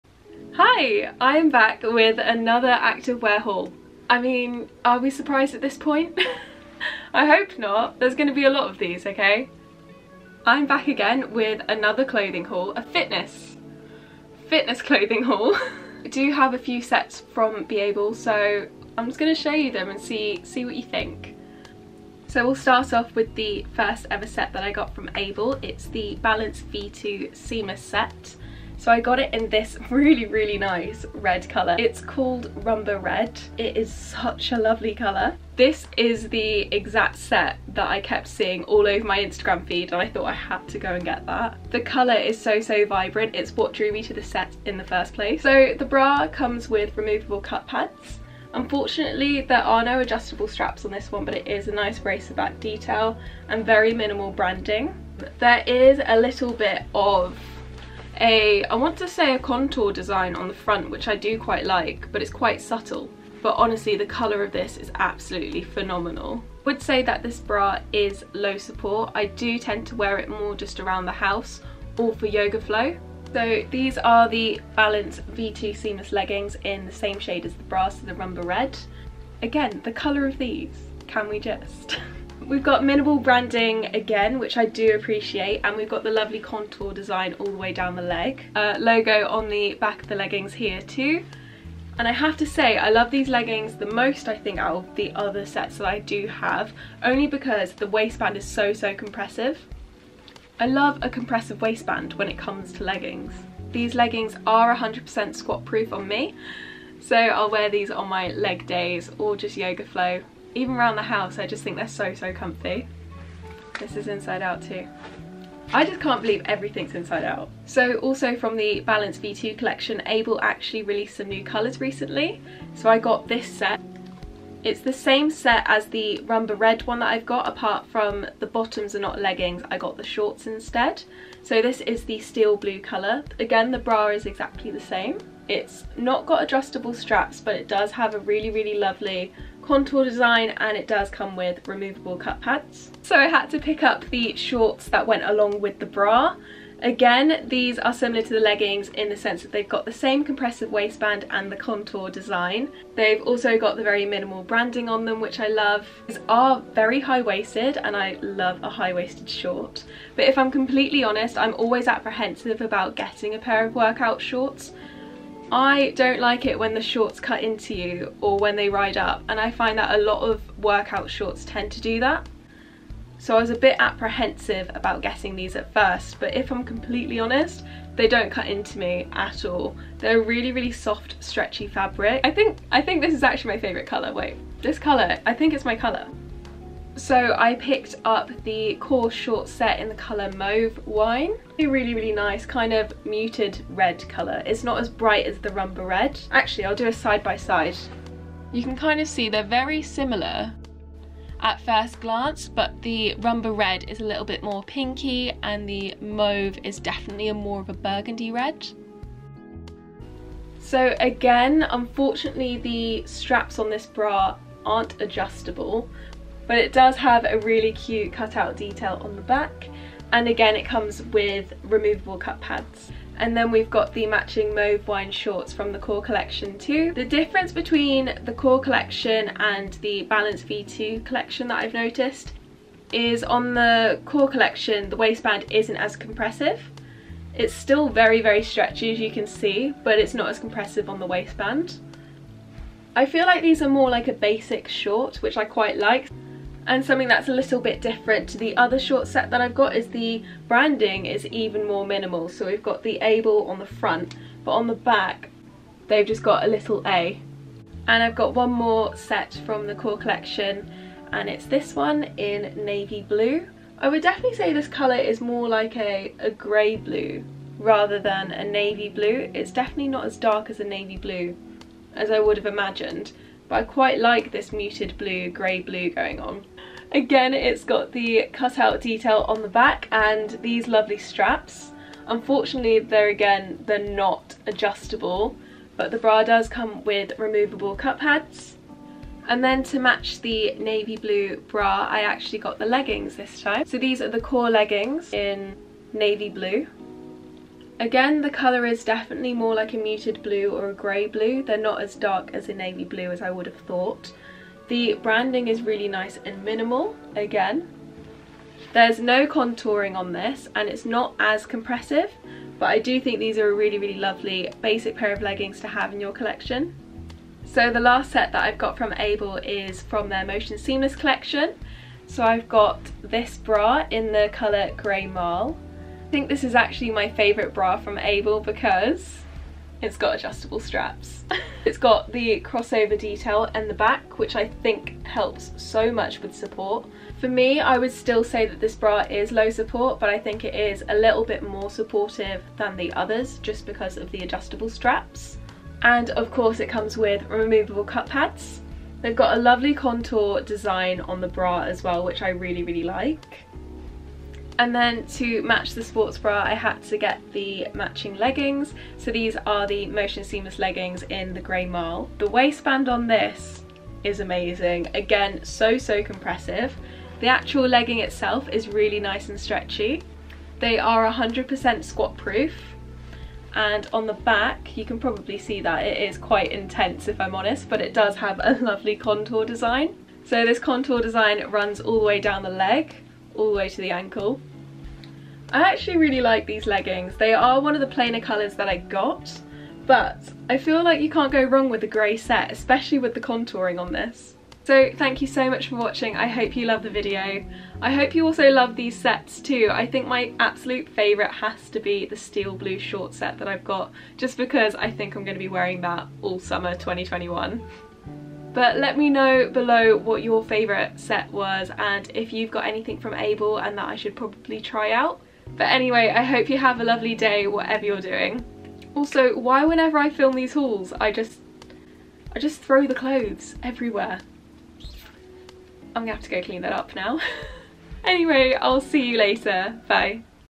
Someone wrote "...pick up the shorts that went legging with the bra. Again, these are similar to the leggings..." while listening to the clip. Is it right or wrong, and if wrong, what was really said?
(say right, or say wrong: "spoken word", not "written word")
wrong: "along", not "legging".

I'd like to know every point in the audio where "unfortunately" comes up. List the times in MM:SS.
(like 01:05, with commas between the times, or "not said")
00:48, 03:31, 04:42.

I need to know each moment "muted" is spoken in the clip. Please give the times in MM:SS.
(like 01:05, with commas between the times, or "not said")
03:13, 04:34, 04:59.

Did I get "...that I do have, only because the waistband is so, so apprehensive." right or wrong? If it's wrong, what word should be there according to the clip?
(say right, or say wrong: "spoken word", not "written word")
wrong: "compressive", not "apprehensive".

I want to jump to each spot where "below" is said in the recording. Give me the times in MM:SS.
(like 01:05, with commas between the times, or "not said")
06:49.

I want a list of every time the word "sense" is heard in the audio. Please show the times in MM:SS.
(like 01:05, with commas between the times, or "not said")
02:29.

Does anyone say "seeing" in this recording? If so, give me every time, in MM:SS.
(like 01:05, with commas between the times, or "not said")
00:38.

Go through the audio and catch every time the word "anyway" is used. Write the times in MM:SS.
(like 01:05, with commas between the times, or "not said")
06:55, 07:08.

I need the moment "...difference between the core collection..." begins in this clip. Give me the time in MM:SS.
03:47.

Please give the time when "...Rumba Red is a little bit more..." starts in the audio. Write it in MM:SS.
03:23.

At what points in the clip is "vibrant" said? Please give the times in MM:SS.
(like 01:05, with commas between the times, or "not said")
00:42.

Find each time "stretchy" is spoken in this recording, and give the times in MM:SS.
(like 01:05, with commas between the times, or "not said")
03:01, 03:58, 06:09.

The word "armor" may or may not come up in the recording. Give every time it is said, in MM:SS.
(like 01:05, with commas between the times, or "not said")
not said.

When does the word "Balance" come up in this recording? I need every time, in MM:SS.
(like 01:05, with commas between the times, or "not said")
00:26, 01:14, 01:58, 03:50.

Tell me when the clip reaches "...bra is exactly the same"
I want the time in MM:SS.
02:13.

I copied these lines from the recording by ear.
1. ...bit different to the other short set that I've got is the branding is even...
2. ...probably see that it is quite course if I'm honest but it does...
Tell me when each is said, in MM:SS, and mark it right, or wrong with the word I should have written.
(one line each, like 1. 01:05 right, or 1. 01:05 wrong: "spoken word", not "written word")
1. 04:07 right
2. 06:14 wrong: "intense", not "course".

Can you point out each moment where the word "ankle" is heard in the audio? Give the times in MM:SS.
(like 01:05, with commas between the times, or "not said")
06:23.